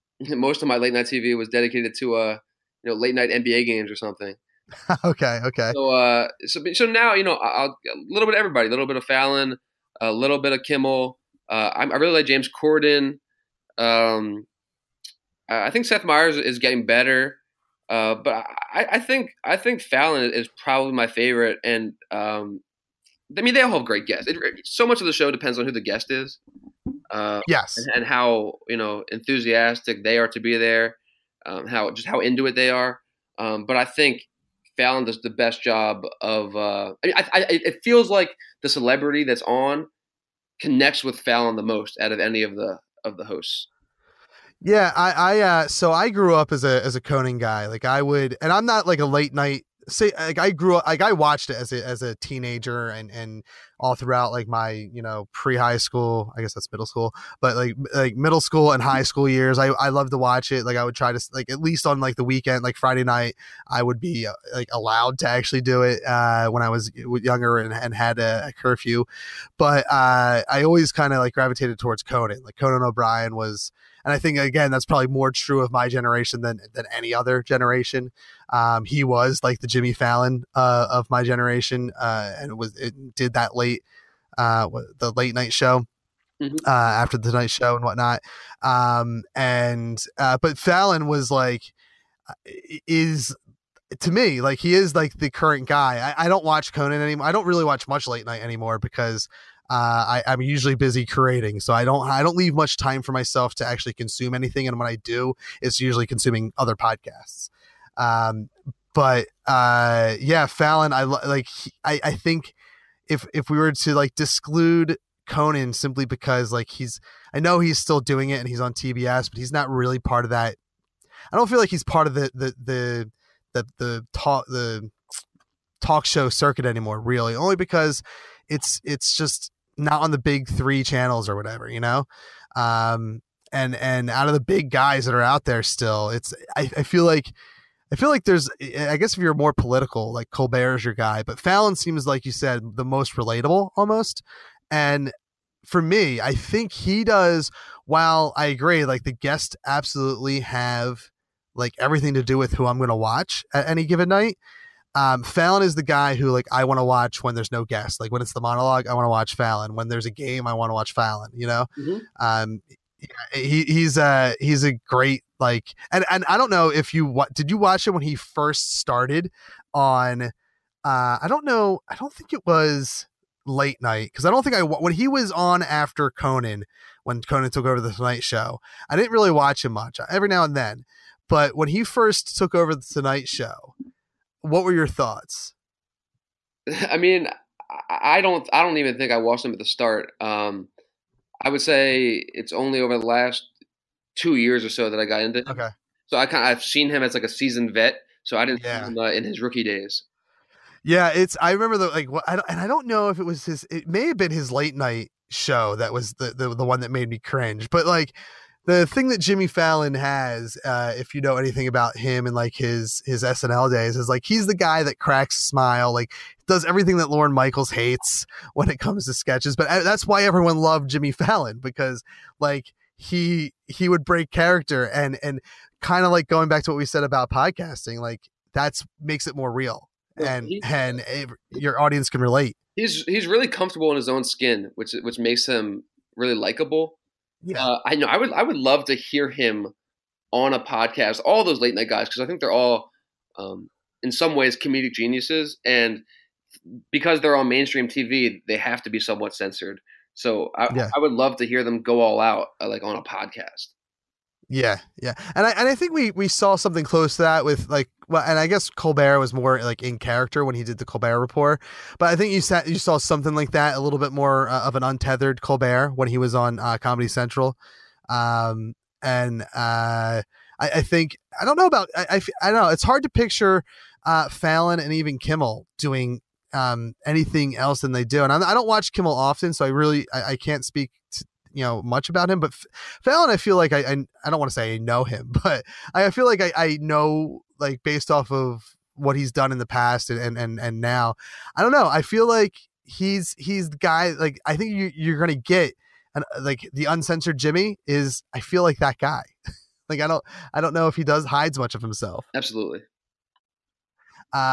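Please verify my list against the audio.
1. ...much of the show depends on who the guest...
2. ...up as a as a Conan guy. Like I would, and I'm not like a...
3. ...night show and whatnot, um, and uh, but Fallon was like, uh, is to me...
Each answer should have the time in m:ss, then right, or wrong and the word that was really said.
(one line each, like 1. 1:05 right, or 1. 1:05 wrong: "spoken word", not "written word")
1. 0:24 right
2. 0:46 right
3. 1:27 right.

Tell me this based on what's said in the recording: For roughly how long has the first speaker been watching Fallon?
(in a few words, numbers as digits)
2 years.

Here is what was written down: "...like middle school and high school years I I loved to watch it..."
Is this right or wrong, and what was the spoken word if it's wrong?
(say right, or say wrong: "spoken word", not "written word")
right.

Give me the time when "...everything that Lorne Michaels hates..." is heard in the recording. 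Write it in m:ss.
3:36.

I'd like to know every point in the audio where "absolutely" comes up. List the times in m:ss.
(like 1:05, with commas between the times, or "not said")
2:29, 5:02.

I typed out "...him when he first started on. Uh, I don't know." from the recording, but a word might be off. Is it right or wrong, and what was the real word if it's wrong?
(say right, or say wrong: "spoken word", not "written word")
right.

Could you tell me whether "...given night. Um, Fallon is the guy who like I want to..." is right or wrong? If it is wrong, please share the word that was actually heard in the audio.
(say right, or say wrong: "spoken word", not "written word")
right.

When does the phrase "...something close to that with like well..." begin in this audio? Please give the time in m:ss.
4:16.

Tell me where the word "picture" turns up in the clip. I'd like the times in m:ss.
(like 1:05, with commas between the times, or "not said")
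4:33.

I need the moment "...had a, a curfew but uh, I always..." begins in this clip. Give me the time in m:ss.
1:07.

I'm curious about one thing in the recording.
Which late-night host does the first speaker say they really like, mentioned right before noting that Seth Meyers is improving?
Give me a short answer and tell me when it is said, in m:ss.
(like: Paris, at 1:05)
James Corden, at 0:12.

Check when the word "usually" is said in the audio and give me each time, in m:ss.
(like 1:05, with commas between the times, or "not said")
1:40, 1:45.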